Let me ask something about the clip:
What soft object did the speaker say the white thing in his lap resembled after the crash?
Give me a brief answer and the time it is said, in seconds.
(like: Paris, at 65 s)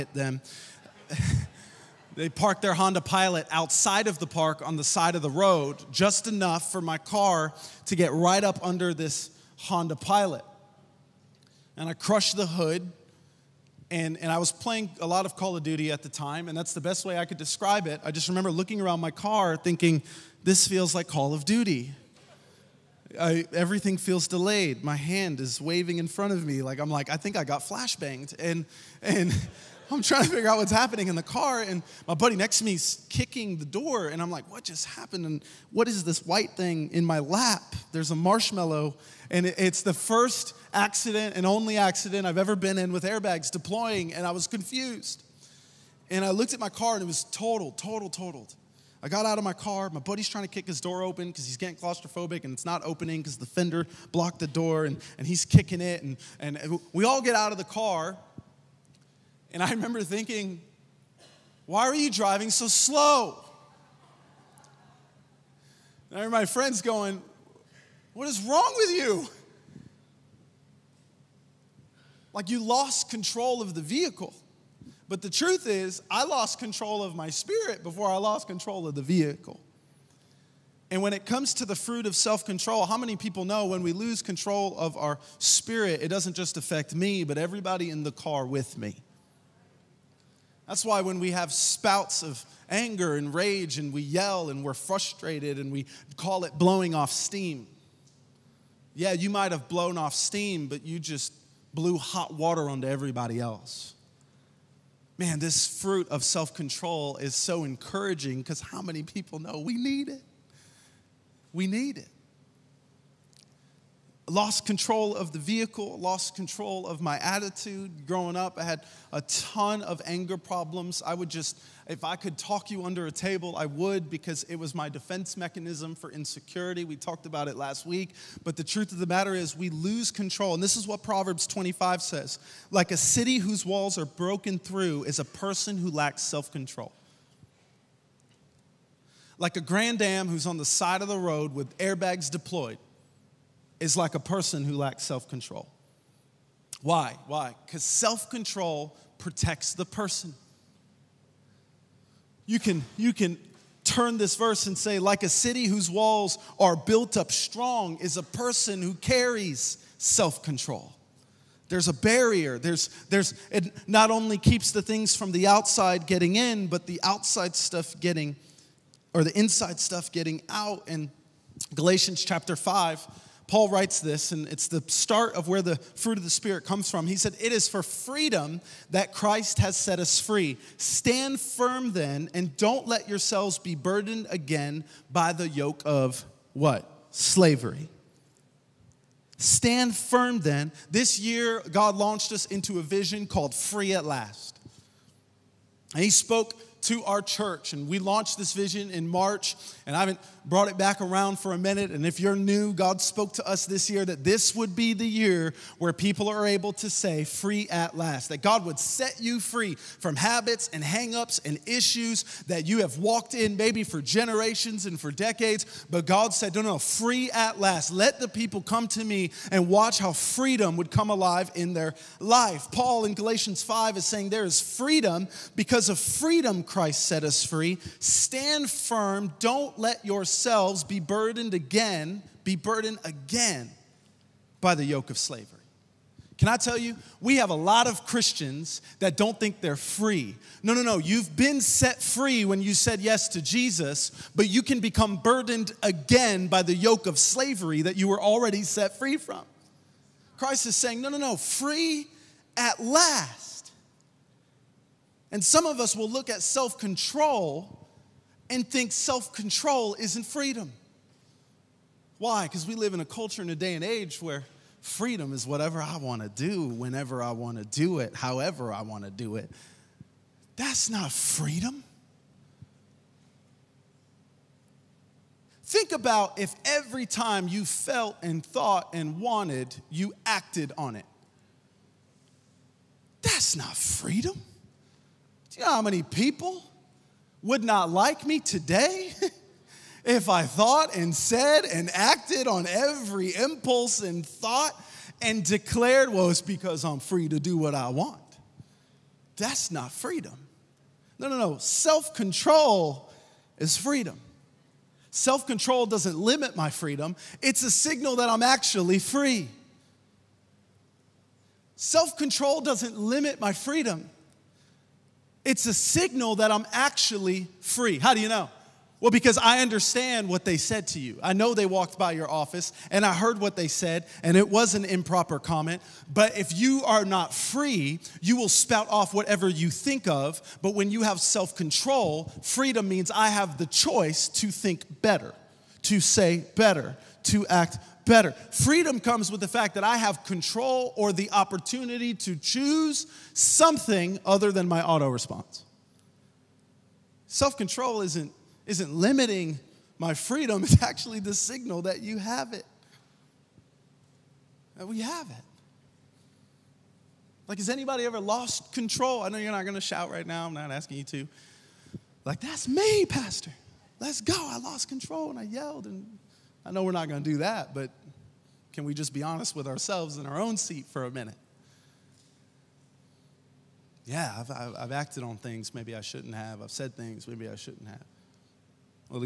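A marshmallow, at 38 s.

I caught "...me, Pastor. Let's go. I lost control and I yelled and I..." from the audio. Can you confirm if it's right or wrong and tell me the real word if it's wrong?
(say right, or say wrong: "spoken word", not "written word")
right.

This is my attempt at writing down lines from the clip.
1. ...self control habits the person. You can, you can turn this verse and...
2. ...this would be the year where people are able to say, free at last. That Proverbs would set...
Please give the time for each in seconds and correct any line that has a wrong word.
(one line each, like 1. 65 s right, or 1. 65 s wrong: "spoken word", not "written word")
1. 147 s wrong: "protects", not "habits"
2. 204 s wrong: "God", not "Proverbs".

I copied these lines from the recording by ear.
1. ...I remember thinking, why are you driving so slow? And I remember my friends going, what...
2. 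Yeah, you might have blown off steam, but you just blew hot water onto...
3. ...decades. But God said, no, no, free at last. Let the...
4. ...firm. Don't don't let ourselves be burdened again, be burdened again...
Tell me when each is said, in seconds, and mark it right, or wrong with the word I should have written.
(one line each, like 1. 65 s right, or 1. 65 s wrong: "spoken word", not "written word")
1. 59 s right
2. 98 s right
3. 215 s right
4. 228 s wrong: "yourselves", not "ourselves".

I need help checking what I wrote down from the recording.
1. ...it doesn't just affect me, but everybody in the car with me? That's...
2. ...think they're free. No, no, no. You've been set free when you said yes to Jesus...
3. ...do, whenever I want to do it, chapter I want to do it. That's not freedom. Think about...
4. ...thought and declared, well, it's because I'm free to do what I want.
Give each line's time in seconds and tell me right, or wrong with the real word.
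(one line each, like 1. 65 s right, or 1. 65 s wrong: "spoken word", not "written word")
1. 86 s right
2. 239 s right
3. 266 s wrong: "however", not "chapter"
4. 294 s right.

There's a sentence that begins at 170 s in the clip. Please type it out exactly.
And Galatians chapter 5, Paul writes this, and it's the start of where the fruit of the Spirit comes from.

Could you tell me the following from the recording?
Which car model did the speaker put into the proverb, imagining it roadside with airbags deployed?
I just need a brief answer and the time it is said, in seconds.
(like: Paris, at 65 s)
Grand Am, at 139 s.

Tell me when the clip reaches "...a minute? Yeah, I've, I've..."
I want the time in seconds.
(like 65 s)
371 s.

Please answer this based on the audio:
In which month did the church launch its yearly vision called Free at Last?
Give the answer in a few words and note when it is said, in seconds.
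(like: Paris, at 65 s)
March, at 199 s.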